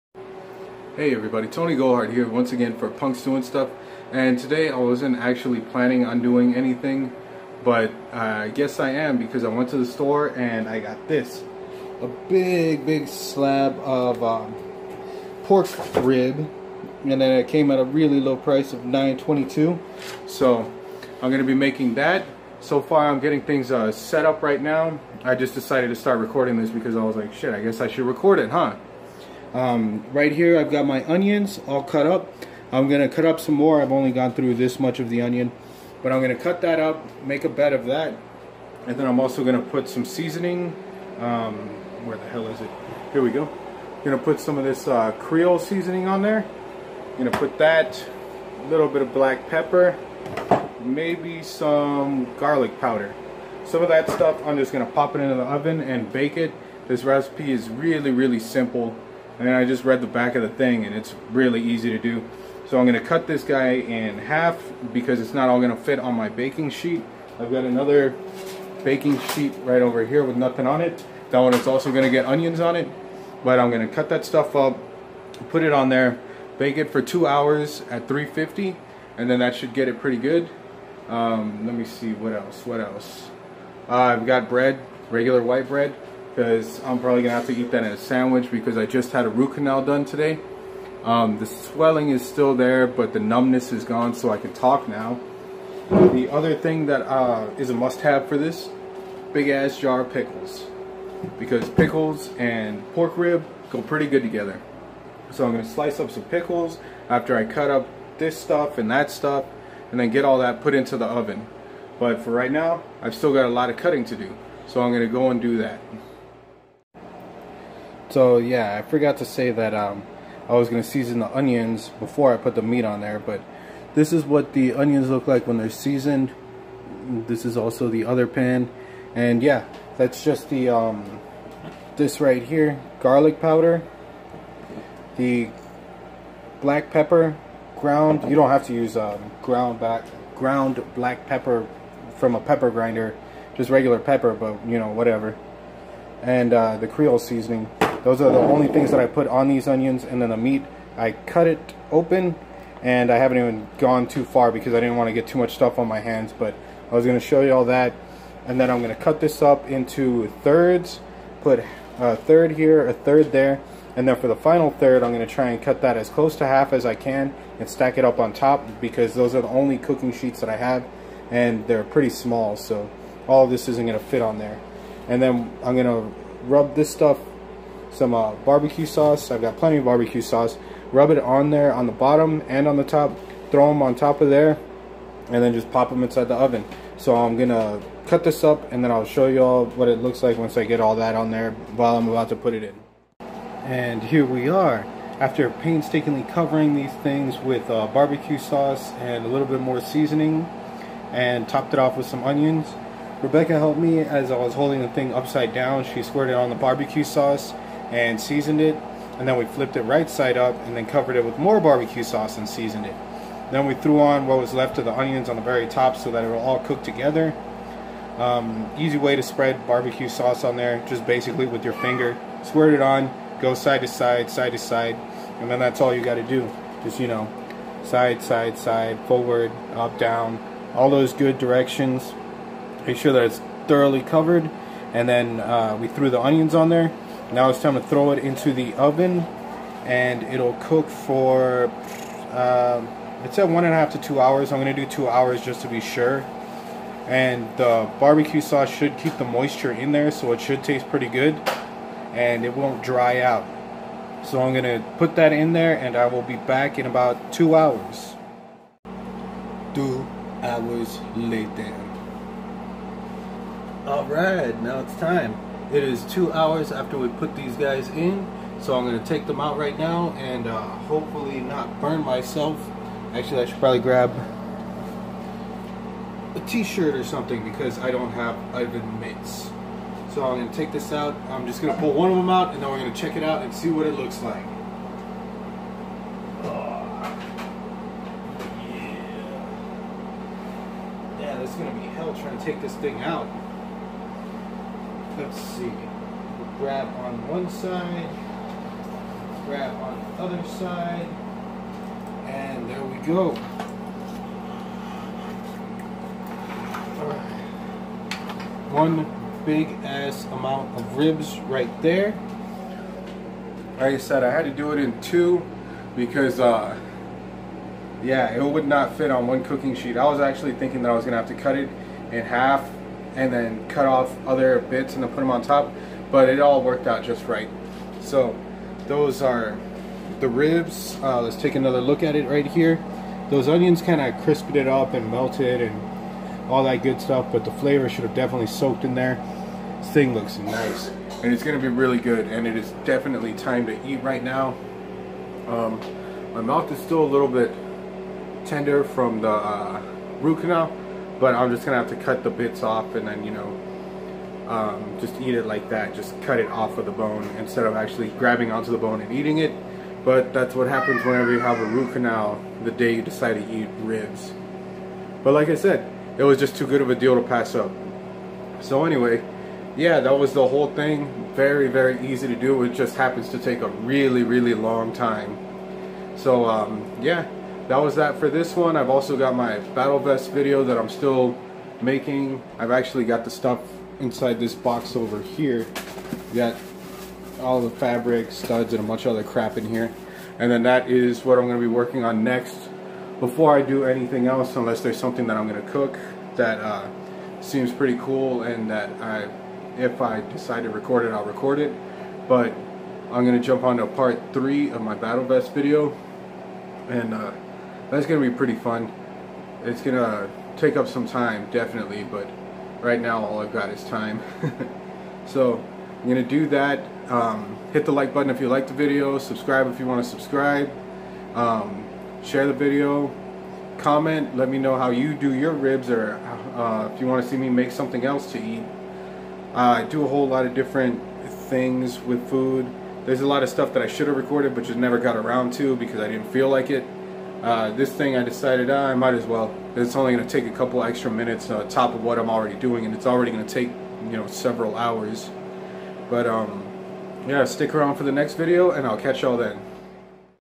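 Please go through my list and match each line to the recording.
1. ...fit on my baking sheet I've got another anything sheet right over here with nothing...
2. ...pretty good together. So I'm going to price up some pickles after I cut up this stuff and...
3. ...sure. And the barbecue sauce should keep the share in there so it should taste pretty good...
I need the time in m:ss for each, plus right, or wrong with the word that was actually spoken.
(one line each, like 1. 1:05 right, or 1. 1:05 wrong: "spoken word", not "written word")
1. 1:05 wrong: "baking", not "anything"
2. 1:43 wrong: "slice", not "price"
3. 4:05 wrong: "moisture", not "share".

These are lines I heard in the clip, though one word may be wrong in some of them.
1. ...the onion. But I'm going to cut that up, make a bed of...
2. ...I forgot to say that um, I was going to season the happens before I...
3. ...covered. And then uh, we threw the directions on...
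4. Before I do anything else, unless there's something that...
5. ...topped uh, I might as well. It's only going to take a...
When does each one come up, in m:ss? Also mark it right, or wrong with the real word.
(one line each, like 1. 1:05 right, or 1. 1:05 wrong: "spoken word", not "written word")
1. 0:35 right
2. 1:58 wrong: "onions", not "happens"
3. 3:54 wrong: "onions", not "directions"
4. 6:33 right
5. 7:18 wrong: "decided", not "topped".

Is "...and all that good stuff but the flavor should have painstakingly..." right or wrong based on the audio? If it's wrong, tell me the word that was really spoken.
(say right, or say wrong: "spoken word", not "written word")
wrong: "definitely", not "painstakingly".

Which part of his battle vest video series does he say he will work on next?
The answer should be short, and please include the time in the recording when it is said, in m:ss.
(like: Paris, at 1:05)
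part 3, at 6:43.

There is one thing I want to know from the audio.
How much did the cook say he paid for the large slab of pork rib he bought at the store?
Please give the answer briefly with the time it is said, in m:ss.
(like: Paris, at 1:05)
$9.22, at 0:18.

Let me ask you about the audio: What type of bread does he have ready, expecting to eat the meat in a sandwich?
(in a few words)
white bread.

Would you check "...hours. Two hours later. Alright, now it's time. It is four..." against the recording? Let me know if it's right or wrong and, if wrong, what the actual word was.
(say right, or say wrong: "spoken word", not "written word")
wrong: "two", not "four".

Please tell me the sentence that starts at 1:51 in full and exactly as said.
But for right now, I've still got a lot of cutting to do, so I'm going to go and do that.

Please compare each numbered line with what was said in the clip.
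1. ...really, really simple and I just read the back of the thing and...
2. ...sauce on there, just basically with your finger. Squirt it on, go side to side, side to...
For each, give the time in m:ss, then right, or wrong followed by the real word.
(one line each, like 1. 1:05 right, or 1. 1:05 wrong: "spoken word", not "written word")
1. 0:57 right
2. 3:40 right.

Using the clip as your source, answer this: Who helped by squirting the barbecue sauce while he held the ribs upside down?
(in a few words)
Rebecca.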